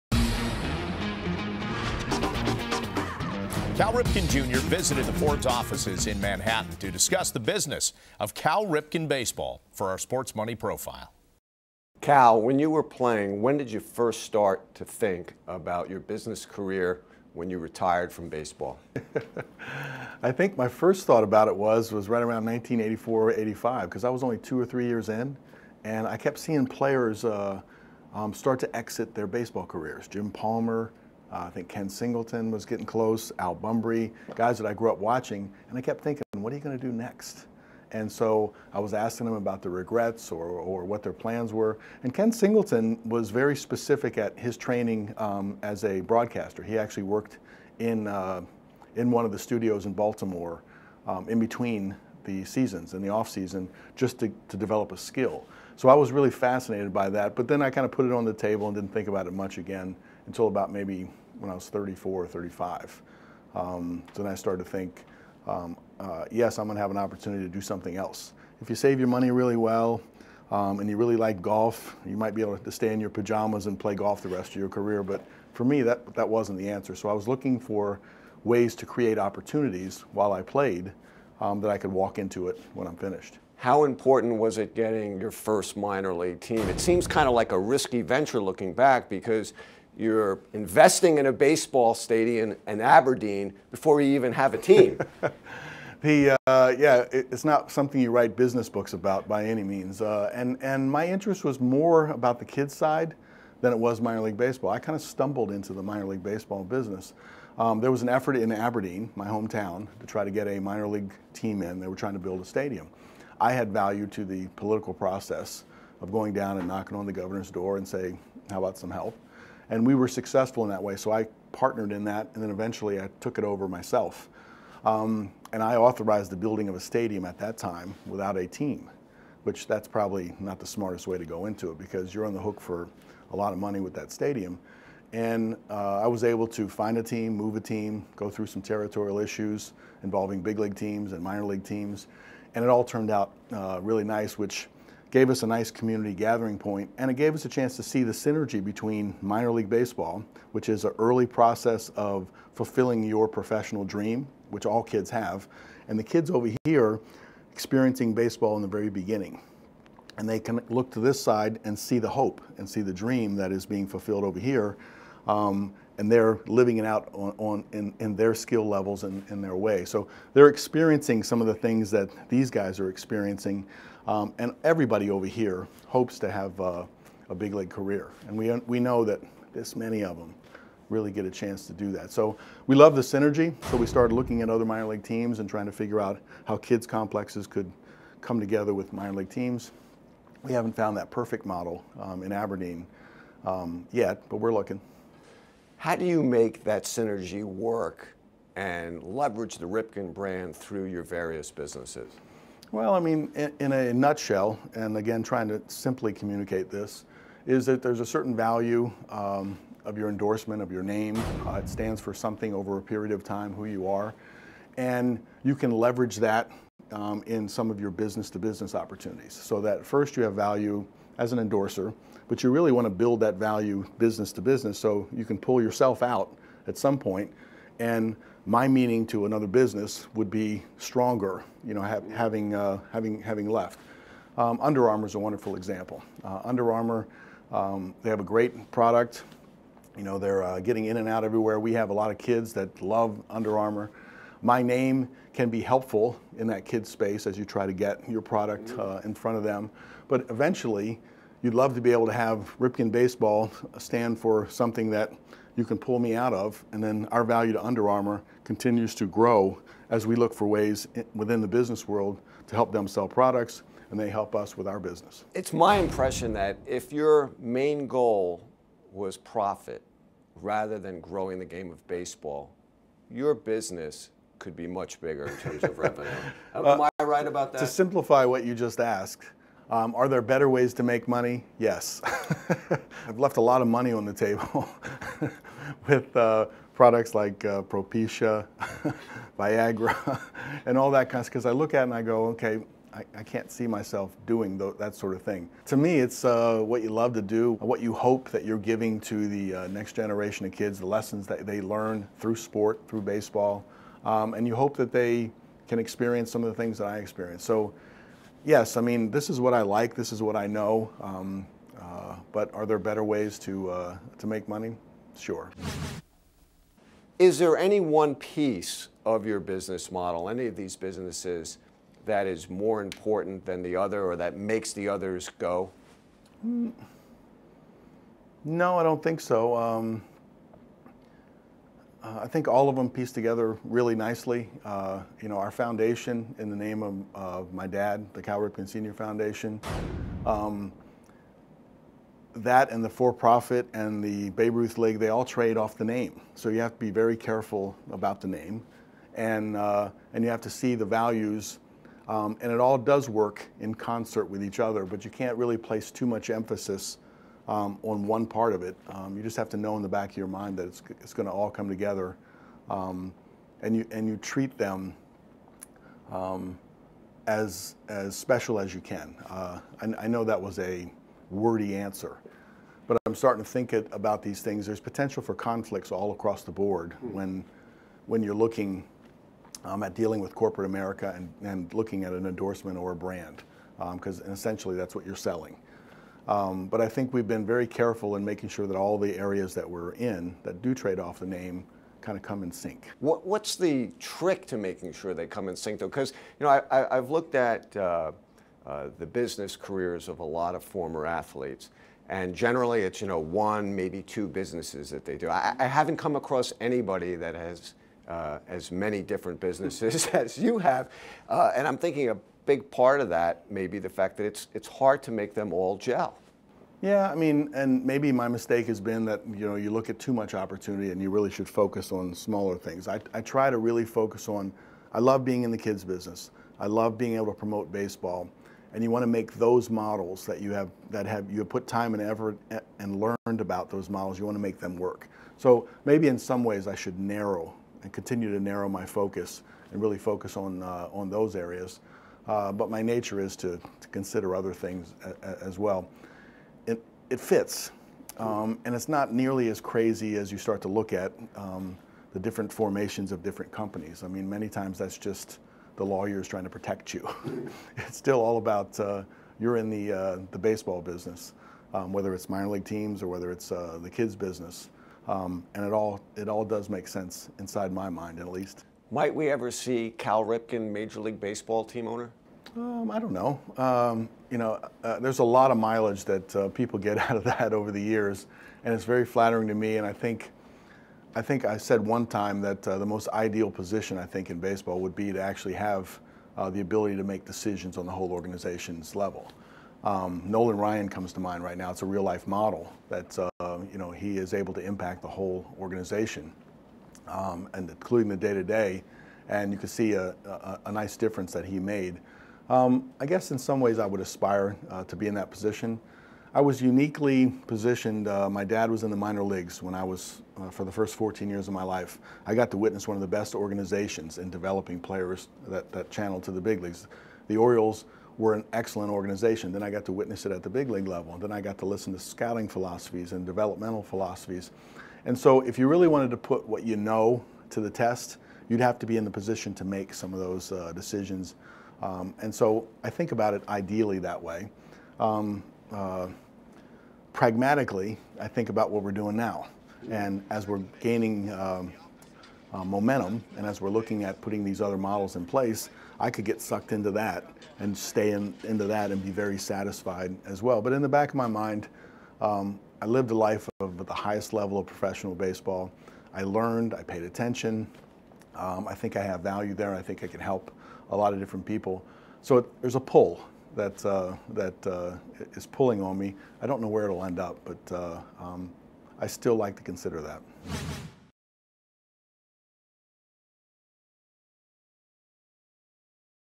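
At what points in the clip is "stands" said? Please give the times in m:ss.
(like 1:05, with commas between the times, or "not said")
3:31, 4:13.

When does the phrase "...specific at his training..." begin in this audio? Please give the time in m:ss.
0:43.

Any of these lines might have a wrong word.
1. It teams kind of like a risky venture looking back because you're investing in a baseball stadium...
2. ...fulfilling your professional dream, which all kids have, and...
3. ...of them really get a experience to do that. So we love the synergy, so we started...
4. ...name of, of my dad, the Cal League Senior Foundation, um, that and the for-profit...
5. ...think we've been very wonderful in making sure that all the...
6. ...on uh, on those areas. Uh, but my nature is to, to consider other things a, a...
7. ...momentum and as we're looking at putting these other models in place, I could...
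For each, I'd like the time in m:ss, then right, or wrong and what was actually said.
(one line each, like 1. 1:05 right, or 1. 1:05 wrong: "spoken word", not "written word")
1. 1:26 wrong: "seems", not "teams"
2. 2:32 right
3. 3:00 wrong: "chance", not "experience"
4. 5:36 wrong: "Ripken", not "League"
5. 6:26 wrong: "careful", not "wonderful"
6. 7:20 right
7. 9:02 right.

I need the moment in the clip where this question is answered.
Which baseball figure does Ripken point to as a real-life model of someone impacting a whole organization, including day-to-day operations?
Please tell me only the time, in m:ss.
8:10.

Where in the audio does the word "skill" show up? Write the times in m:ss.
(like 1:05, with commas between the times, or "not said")
0:54, 2:48.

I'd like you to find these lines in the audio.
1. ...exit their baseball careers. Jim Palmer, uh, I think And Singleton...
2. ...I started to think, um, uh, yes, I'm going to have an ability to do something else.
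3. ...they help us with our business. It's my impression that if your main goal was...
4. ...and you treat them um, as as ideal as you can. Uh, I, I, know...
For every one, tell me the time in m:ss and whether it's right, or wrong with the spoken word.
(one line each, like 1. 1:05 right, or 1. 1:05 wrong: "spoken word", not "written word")
1. 0:28 wrong: "Ken", not "And"
2. 1:04 wrong: "opportunity", not "ability"
3. 4:23 right
4. 6:03 wrong: "special", not "ideal".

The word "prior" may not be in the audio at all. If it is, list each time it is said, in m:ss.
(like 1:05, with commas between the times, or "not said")
not said.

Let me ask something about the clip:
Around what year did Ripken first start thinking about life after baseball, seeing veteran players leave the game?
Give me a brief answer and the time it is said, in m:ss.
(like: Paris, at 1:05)
1984, at 0:22.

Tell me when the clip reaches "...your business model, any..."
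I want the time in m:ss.
5:19.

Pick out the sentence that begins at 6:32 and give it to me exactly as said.
What, what's the trick to making sure they come in sync, though?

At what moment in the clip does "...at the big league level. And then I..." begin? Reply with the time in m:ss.
8:40.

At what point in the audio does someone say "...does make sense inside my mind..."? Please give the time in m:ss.
7:46.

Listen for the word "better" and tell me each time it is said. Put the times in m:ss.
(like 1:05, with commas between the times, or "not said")
4:40, 5:12.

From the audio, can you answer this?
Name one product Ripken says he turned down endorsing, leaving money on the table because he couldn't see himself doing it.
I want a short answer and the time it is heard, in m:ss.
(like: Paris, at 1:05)
Propecia, at 4:47.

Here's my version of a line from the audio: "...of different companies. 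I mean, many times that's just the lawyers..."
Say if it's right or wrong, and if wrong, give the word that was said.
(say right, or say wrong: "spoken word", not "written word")
right.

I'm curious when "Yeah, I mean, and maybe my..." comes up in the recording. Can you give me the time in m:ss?
6:56.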